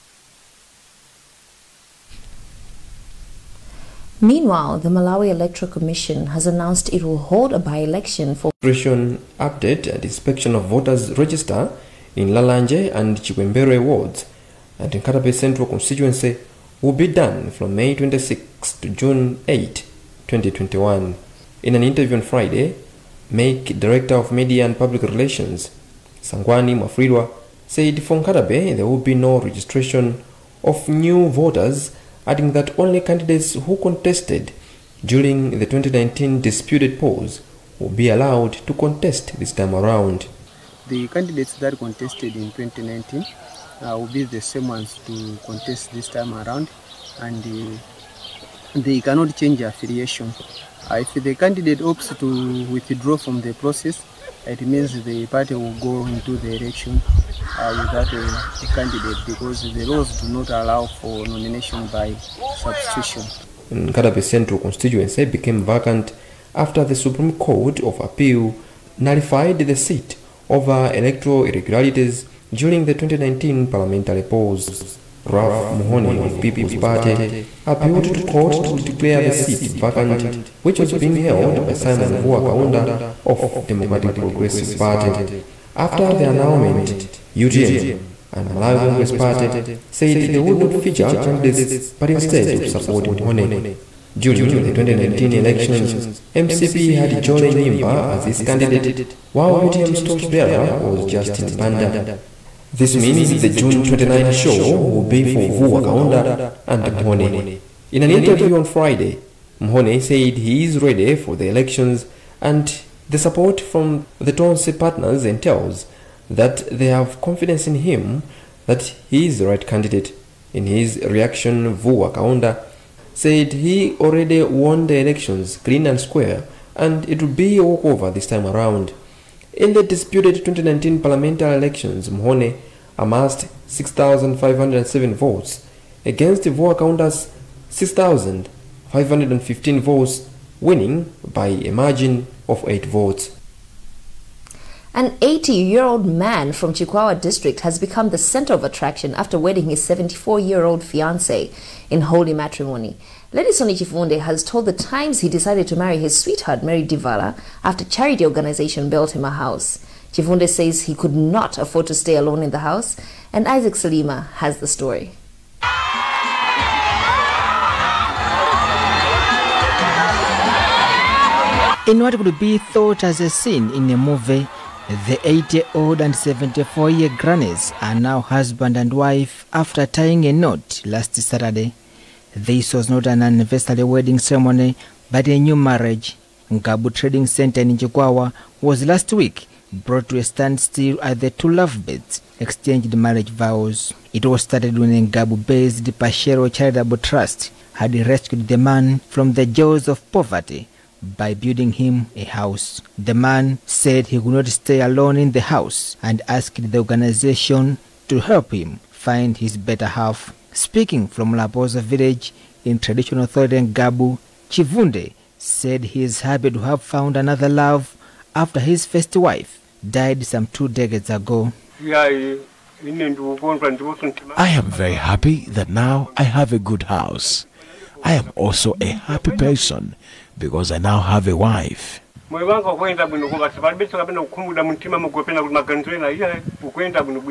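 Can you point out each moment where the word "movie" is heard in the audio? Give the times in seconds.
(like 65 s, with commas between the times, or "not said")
173 s.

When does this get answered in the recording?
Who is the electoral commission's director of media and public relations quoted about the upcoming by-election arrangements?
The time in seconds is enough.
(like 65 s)
26 s.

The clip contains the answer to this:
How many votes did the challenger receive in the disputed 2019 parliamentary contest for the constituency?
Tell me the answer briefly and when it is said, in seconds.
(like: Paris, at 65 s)
6,507, at 133 s.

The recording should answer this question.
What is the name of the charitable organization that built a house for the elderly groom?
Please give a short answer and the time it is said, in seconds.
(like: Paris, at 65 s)
Pashero Charitable Trust, at 195 s.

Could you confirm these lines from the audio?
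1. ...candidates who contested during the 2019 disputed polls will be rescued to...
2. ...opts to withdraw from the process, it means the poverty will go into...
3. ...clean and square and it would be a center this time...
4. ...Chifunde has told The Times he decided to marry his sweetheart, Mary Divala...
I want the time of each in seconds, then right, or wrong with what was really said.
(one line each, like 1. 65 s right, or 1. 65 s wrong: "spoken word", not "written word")
1. 32 s wrong: "allowed", not "rescued"
2. 51 s wrong: "party", not "poverty"
3. 125 s wrong: "walkover", not "center"
4. 153 s right.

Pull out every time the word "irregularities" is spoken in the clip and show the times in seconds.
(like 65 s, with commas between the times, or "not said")
71 s.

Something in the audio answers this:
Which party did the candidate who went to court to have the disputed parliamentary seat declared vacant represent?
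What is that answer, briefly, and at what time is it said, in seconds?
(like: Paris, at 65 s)
People's Party, at 76 s.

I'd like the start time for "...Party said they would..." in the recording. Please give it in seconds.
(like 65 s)
89 s.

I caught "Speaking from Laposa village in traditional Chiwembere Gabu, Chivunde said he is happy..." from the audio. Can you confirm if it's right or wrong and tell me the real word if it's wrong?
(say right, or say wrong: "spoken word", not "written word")
wrong: "Tholen", not "Chiwembere".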